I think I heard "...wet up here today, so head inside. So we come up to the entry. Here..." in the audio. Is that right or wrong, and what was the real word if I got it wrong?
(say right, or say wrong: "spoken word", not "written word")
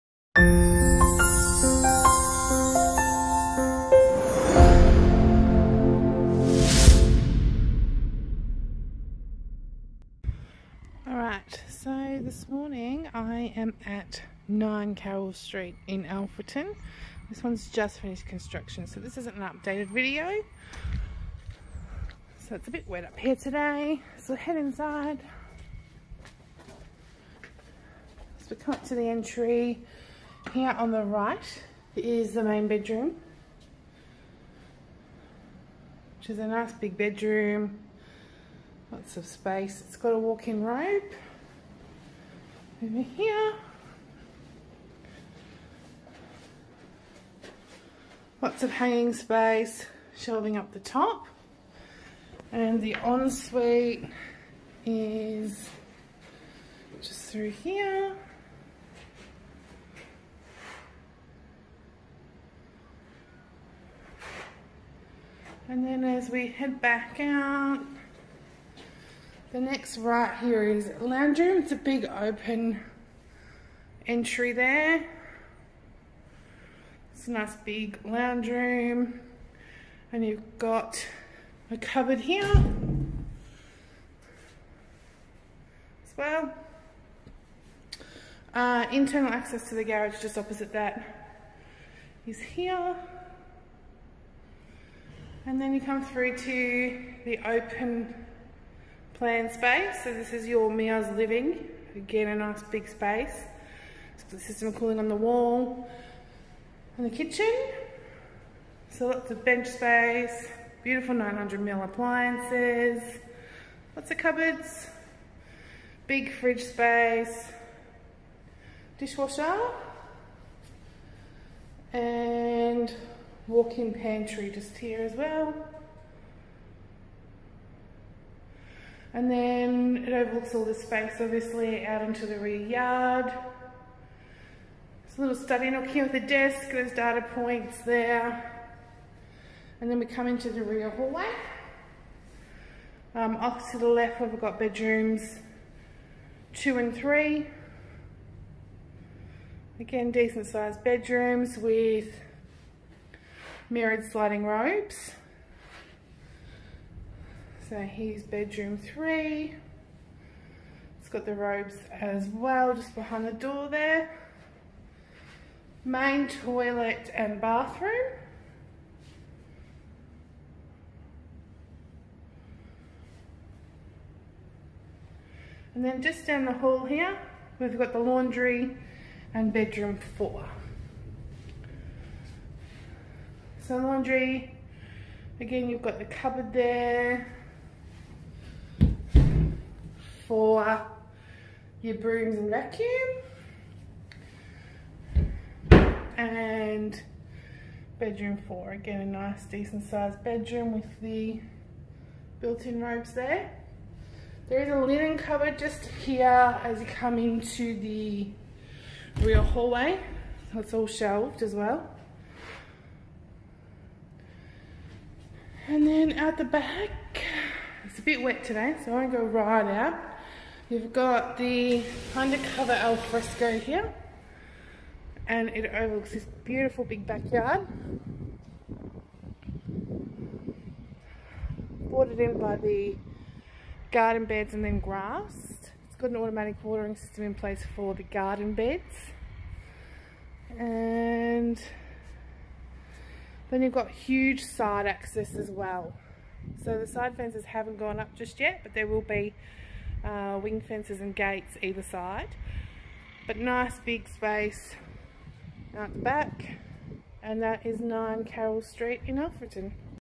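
right.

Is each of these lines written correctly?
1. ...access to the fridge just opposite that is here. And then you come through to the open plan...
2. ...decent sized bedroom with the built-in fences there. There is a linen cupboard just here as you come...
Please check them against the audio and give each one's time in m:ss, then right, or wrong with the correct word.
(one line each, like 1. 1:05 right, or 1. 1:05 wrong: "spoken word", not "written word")
1. 1:29 wrong: "garage", not "fridge"
2. 3:19 wrong: "robes", not "fences".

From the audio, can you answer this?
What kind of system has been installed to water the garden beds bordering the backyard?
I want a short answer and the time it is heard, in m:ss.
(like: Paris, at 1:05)
Automatic watering system, at 3:56.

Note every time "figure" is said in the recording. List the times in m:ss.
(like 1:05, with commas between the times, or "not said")
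not said.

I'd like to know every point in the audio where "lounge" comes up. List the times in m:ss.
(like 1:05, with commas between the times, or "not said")
1:10, 1:18.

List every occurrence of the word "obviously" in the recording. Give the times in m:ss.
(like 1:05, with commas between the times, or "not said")
2:11.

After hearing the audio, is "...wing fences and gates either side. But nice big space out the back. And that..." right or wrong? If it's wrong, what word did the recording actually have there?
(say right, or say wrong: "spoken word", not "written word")
right.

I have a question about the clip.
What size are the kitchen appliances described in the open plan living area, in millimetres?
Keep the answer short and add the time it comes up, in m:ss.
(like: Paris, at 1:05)
900 mil, at 1:51.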